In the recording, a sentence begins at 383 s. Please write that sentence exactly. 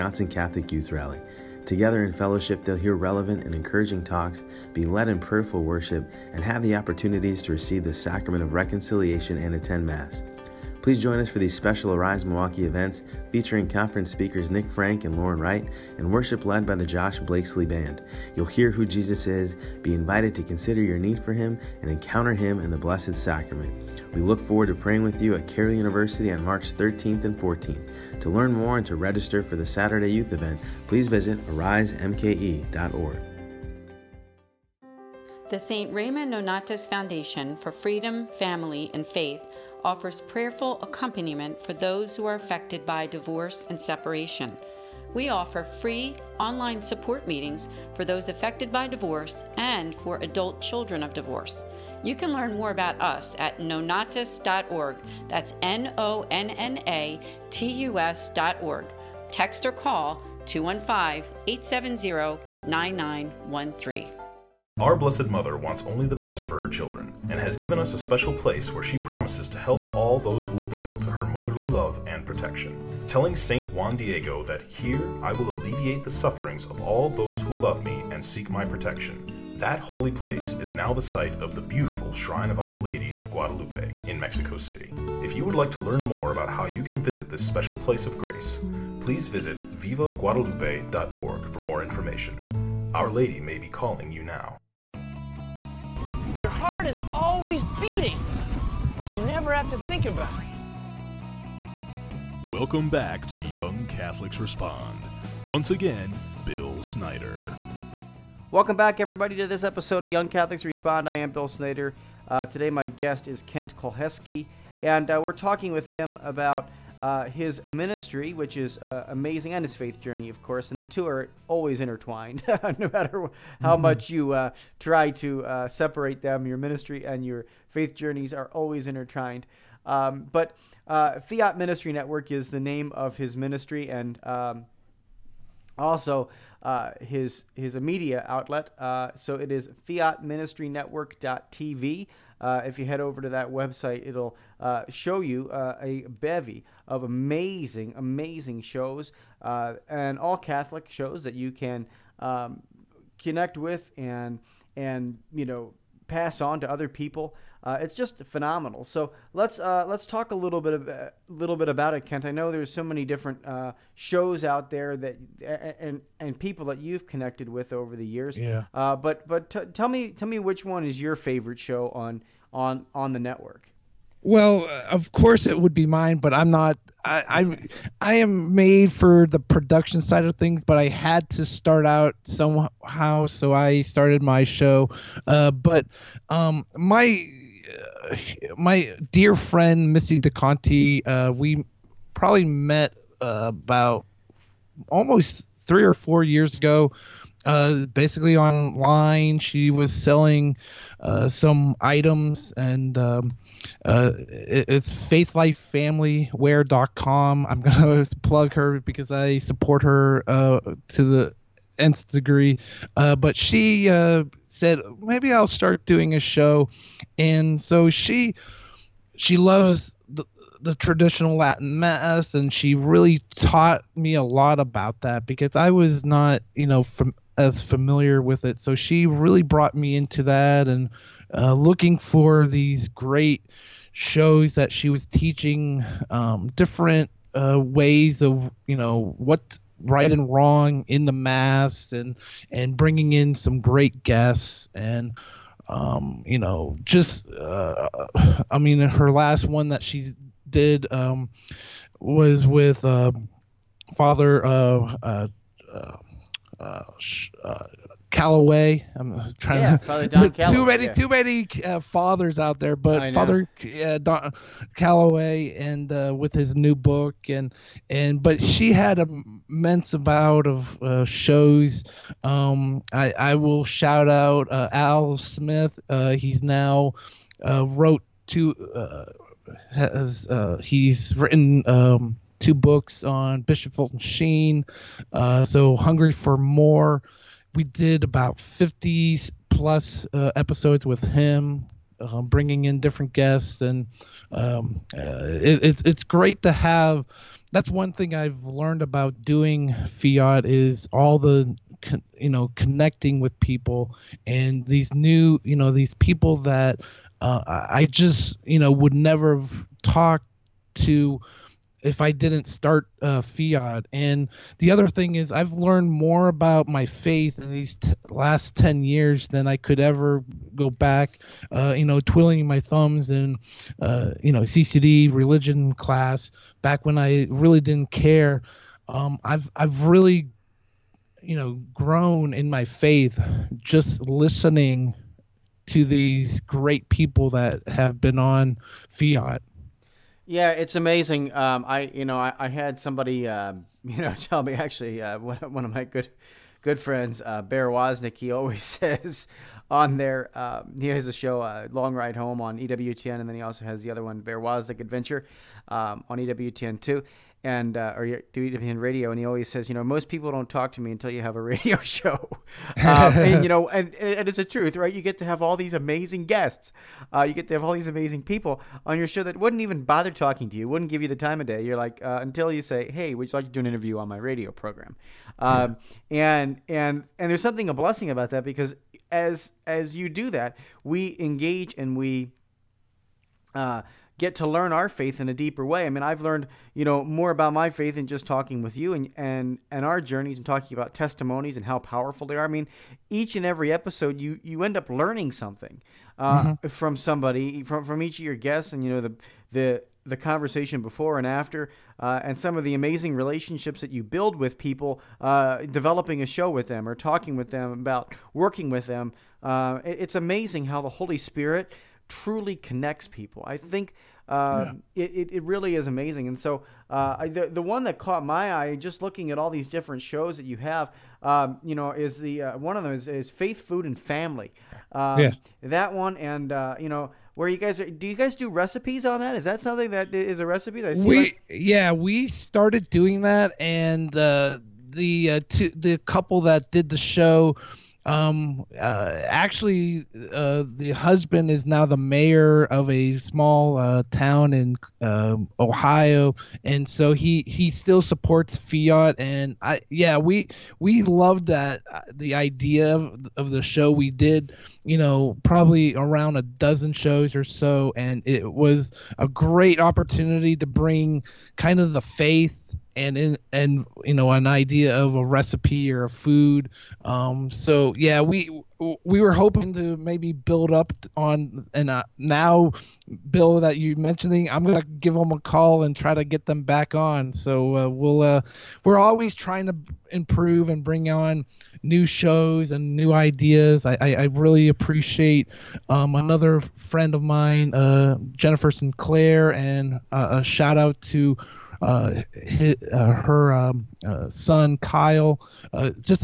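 Uh, get to learn our faith in a deeper way.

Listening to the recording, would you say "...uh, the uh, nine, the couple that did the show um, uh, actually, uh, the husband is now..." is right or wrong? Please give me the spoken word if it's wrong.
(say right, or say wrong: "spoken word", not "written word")
wrong: "two", not "nine".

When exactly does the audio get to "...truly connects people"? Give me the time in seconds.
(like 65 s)
412 s.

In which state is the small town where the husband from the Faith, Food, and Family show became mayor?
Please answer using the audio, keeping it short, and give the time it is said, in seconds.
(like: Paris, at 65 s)
Ohio, at 445 s.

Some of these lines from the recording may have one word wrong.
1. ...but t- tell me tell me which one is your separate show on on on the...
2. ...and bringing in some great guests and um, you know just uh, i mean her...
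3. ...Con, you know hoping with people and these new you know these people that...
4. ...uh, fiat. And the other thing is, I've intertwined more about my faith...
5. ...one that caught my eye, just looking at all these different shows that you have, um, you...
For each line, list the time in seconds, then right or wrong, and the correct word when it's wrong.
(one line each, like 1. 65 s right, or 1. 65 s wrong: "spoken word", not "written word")
1. 169 s wrong: "favorite", not "separate"
2. 242 s right
3. 301 s wrong: "connecting", not "hoping"
4. 313 s wrong: "learned", not "intertwined"
5. 417 s right.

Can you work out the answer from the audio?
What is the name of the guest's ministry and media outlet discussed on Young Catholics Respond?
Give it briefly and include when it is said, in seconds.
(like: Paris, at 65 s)
Fiat Ministry Network, at 131 s.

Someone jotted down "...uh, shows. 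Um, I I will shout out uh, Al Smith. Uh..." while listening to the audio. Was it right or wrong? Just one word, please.
right.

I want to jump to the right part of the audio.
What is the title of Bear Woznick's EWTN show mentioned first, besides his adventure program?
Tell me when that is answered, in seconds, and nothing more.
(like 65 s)
351 s.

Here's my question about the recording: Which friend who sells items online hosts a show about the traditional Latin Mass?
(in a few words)
Missy DeConti.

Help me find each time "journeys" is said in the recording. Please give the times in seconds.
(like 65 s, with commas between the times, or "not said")
120 s, 127 s, 390 s.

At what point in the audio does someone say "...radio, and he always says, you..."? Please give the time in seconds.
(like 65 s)
358 s.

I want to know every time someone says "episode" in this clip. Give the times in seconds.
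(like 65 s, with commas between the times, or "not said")
109 s, 290 s, 393 s.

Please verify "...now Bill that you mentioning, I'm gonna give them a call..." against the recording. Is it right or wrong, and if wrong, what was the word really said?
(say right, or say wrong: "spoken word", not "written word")
right.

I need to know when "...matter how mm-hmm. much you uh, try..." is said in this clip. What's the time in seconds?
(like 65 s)
122 s.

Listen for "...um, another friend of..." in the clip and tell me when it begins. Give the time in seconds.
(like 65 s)
485 s.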